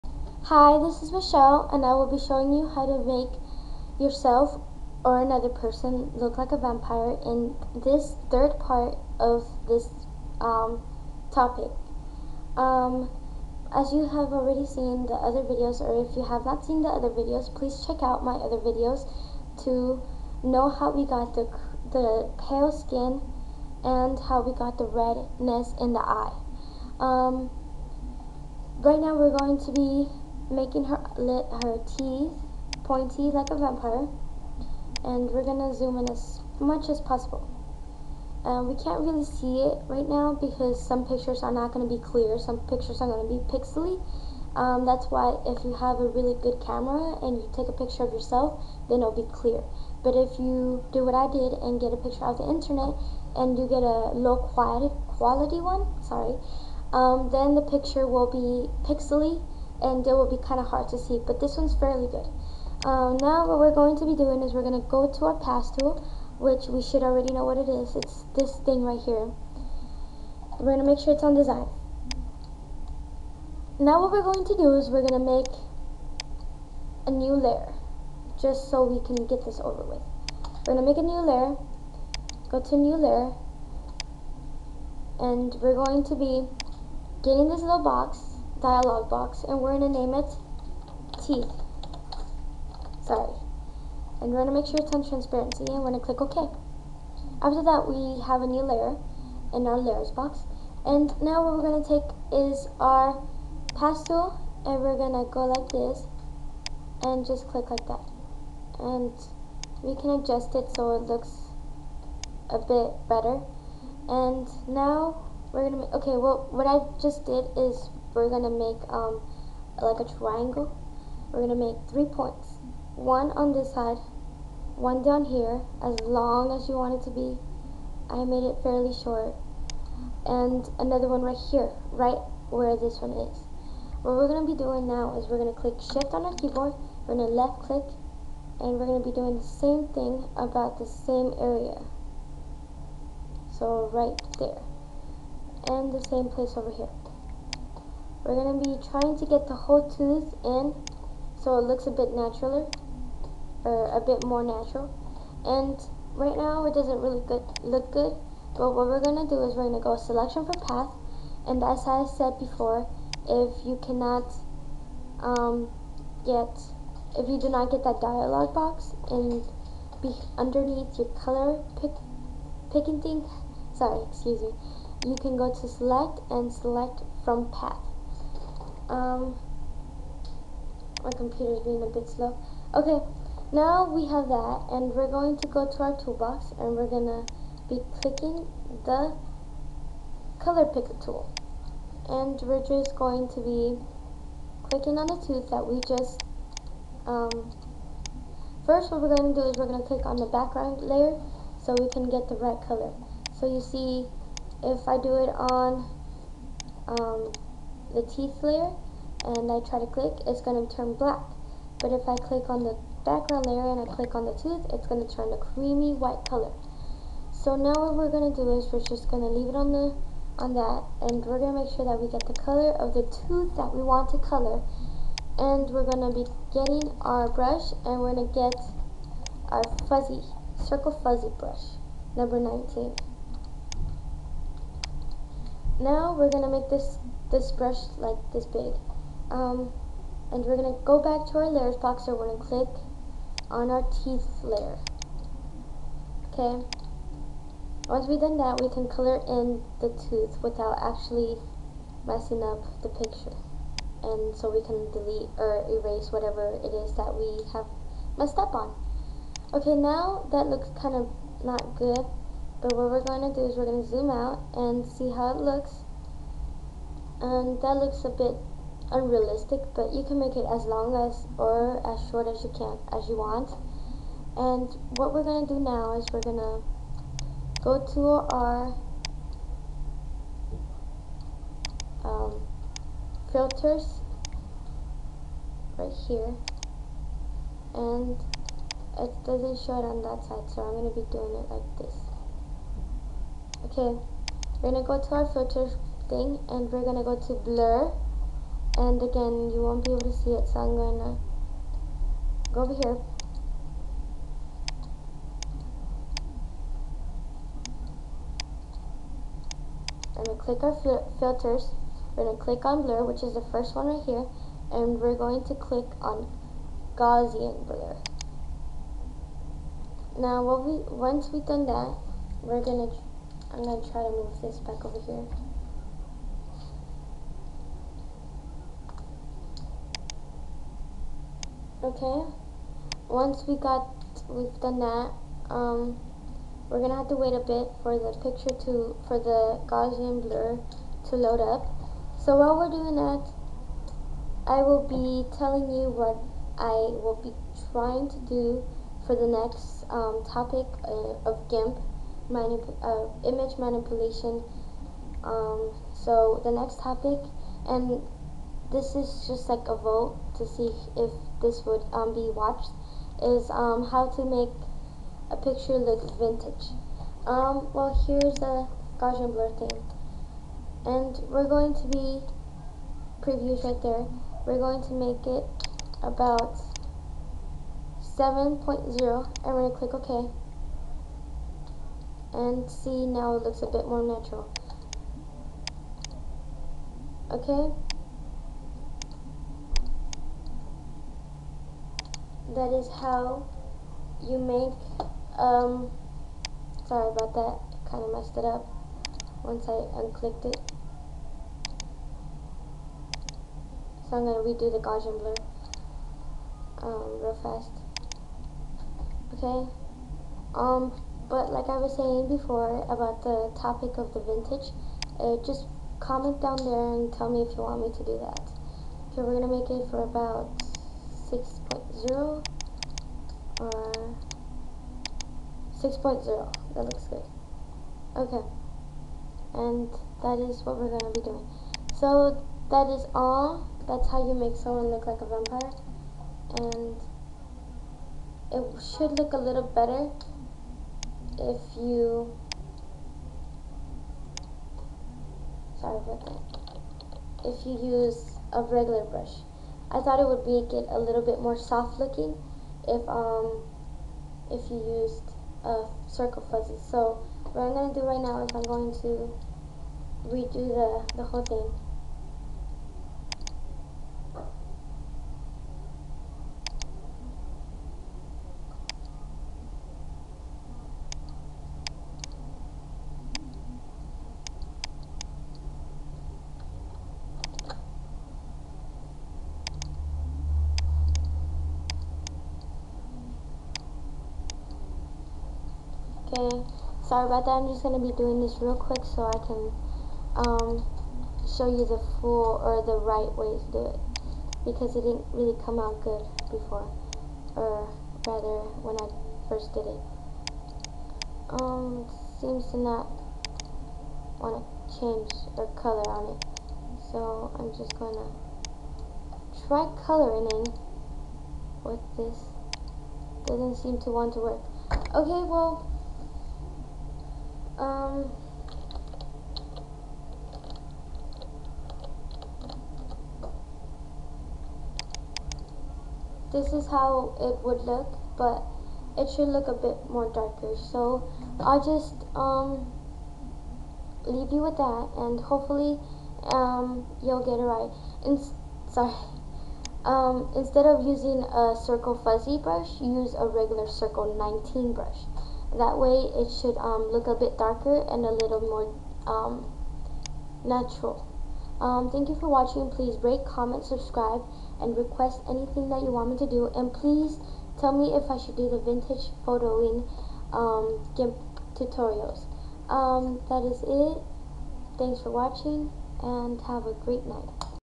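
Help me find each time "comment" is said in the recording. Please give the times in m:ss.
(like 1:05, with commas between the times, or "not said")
6:56, 9:13.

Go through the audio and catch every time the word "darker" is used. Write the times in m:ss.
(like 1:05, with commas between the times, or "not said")
8:50, 9:07.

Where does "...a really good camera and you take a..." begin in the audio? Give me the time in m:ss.
0:46.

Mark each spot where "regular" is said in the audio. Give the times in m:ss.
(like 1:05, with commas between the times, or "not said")
7:28, 9:03.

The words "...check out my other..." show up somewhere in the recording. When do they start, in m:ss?
0:17.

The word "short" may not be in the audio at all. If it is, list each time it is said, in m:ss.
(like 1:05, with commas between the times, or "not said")
2:08, 4:32.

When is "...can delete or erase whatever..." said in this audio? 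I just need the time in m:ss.
4:14.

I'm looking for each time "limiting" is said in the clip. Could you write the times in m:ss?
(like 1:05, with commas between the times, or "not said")
not said.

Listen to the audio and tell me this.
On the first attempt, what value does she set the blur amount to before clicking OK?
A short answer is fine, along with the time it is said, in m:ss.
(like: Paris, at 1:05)
7.0, at 6:18.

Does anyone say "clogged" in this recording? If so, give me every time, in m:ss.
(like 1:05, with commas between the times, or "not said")
not said.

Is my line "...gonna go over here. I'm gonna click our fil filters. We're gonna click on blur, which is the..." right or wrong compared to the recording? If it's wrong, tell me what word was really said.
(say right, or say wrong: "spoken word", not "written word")
right.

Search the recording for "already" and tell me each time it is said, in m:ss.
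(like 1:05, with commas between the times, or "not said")
0:14, 1:07.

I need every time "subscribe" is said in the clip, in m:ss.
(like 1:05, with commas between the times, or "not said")
9:13.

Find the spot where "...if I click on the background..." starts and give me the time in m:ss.
3:31.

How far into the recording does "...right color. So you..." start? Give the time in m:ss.
3:22.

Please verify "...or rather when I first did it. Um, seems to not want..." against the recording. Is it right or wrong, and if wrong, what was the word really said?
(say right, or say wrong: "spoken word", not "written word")
right.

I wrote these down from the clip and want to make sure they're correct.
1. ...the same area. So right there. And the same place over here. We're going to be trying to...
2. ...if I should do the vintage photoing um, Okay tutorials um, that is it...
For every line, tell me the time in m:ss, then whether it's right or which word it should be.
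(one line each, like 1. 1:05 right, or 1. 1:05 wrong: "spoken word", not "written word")
1. 2:20 right
2. 9:18 wrong: "GIMP", not "Okay".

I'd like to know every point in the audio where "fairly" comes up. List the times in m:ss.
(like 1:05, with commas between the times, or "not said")
1:01, 2:08.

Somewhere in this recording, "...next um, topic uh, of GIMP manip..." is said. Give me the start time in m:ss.
5:49.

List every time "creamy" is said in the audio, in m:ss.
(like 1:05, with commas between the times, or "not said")
3:35.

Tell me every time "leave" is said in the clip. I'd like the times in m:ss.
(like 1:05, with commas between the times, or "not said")
3:39, 8:54.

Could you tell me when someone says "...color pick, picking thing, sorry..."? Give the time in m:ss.
2:51.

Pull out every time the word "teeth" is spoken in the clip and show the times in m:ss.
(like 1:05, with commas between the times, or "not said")
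0:31, 1:31, 3:28, 4:04.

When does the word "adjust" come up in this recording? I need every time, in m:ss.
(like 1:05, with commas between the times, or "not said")
1:50.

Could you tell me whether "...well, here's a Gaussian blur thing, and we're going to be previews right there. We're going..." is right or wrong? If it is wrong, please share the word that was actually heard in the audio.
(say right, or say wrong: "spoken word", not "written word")
right.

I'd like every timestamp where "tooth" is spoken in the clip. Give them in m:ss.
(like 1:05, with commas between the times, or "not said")
2:29, 3:15, 3:34, 3:43, 4:10.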